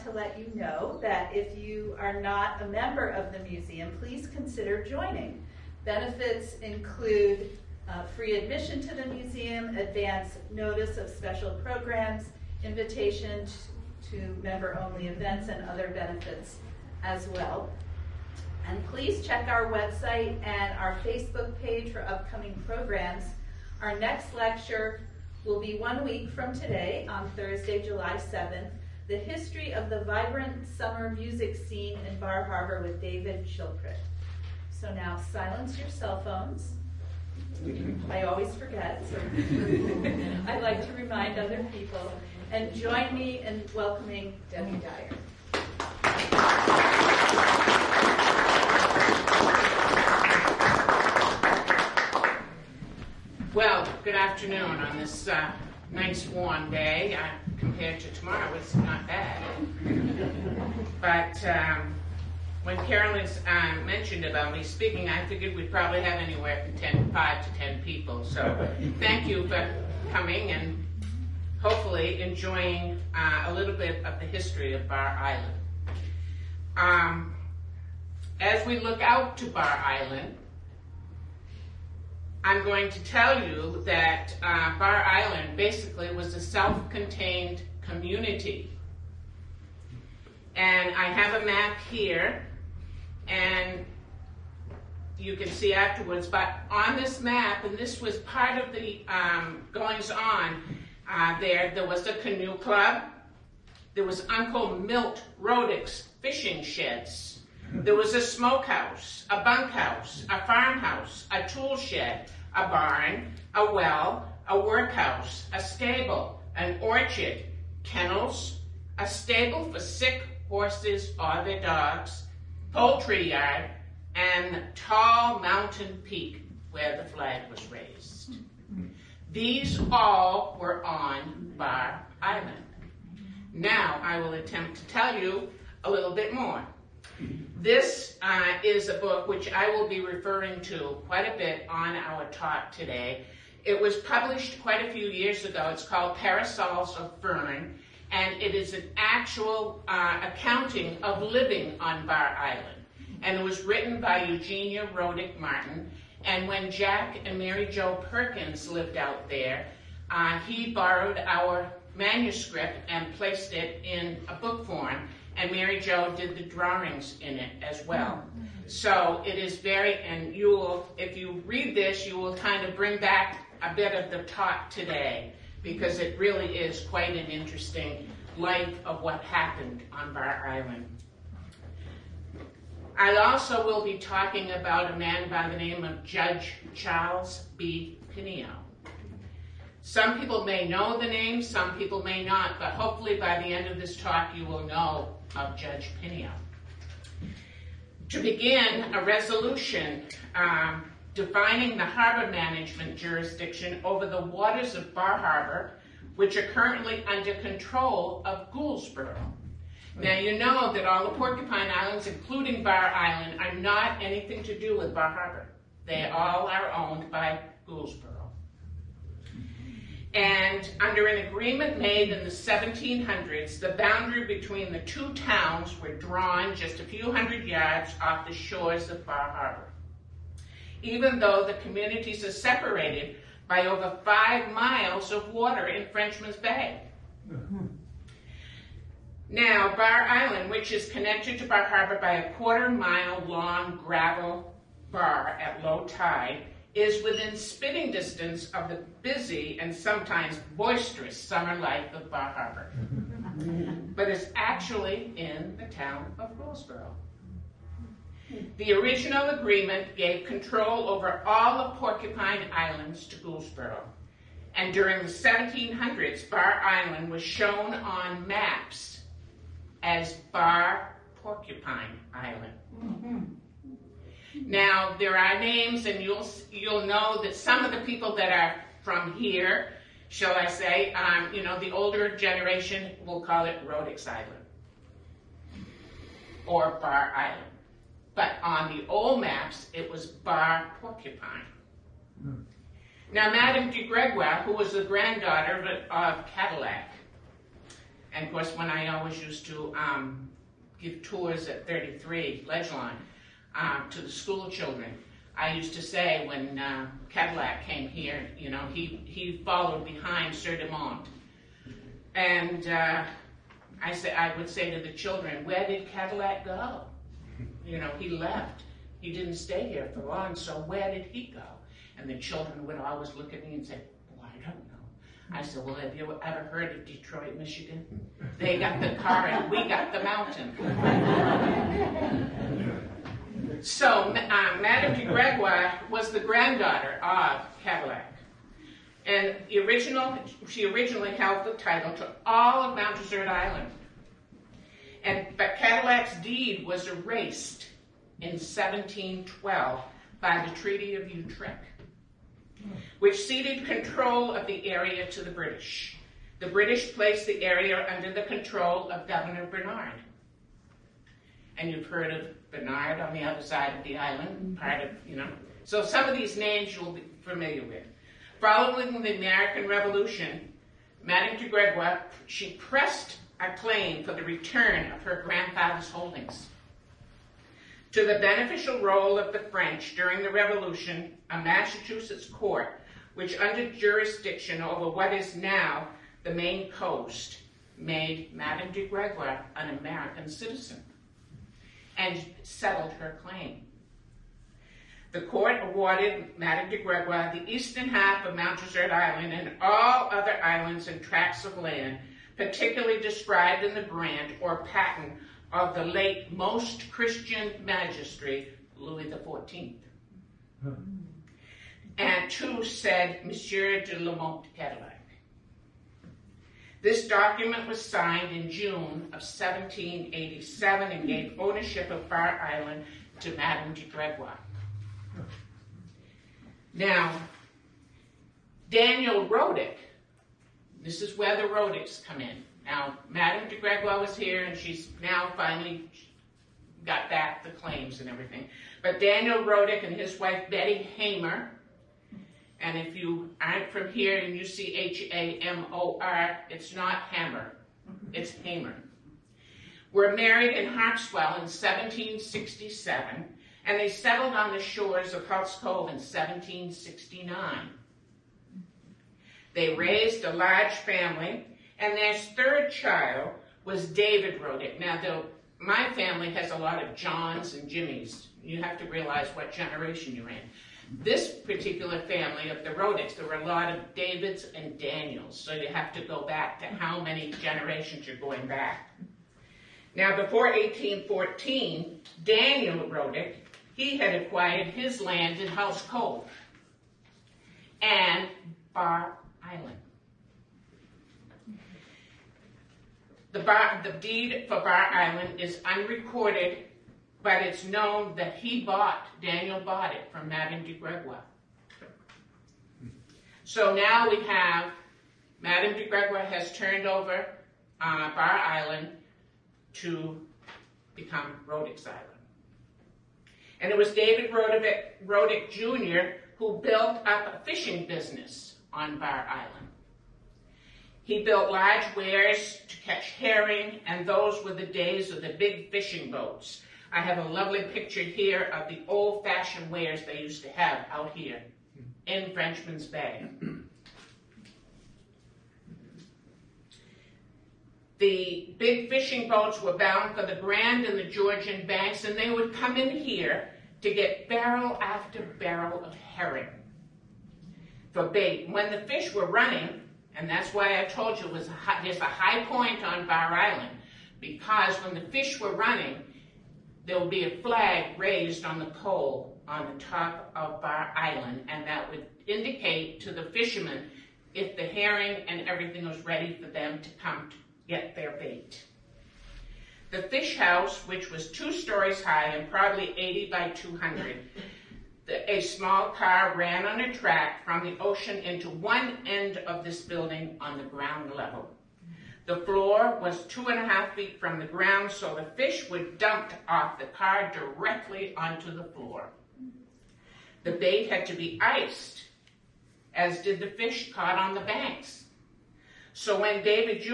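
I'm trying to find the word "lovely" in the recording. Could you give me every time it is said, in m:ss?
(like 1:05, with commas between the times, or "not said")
8:47.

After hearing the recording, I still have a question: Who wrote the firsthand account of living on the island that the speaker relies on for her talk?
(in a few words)
Eugenia Rodick Martin.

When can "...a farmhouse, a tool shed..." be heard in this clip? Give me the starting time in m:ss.
1:50.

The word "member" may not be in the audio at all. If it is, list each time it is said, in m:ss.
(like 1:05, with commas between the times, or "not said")
0:02, 0:14.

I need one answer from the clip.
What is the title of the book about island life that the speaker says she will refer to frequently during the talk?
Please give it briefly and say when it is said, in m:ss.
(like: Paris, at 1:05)
Parasols of Fern, at 2:26.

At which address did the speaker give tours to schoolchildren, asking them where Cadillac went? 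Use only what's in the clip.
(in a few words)
33 Ledgelawn.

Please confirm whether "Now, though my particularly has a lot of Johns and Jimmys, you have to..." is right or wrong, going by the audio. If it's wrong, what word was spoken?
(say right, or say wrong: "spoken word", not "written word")
wrong: "family", not "particularly".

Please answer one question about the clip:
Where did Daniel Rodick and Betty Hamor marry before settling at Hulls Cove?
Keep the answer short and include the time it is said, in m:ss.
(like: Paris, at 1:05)
Harpswell, at 7:30.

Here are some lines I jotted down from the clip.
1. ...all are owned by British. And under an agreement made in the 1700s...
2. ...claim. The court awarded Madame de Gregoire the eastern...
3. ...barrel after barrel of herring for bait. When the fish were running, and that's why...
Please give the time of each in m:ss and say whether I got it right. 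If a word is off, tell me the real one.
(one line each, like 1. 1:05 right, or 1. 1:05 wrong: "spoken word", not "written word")
1. 3:36 wrong: "Gouldsboro", not "British"
2. 6:33 right
3. 9:04 right.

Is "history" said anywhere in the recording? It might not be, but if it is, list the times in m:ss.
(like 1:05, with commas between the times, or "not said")
0:29, 1:14.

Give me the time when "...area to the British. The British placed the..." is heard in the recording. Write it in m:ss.
5:54.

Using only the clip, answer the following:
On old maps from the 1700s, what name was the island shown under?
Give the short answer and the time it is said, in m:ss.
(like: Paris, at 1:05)
Bar Porcupine Island, at 4:30.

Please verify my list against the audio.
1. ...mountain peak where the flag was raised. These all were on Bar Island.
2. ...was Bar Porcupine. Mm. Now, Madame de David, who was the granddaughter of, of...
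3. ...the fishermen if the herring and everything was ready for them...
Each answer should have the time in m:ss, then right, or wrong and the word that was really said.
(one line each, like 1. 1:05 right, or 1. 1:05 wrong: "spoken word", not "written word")
1. 2:05 right
2. 4:49 wrong: "Gregoire", not "David"
3. 9:23 right.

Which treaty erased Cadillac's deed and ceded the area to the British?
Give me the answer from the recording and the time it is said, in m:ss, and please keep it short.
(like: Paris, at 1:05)
Treaty of Utrecht, at 5:50.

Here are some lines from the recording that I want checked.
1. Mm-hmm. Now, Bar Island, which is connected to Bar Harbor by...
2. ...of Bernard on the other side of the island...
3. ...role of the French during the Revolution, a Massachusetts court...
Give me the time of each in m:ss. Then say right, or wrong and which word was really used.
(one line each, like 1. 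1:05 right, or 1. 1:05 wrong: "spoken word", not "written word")
1. 3:57 right
2. 6:02 right
3. 6:18 right.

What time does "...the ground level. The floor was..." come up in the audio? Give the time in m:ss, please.
9:40.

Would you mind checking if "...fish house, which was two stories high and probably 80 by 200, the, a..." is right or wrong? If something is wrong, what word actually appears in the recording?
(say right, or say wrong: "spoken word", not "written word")
right.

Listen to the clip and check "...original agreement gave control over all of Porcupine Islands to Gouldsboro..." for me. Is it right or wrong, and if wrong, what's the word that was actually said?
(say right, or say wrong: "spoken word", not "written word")
right.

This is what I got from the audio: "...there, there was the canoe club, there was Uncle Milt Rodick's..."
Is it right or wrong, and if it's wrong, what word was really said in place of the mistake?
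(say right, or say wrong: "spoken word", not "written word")
right.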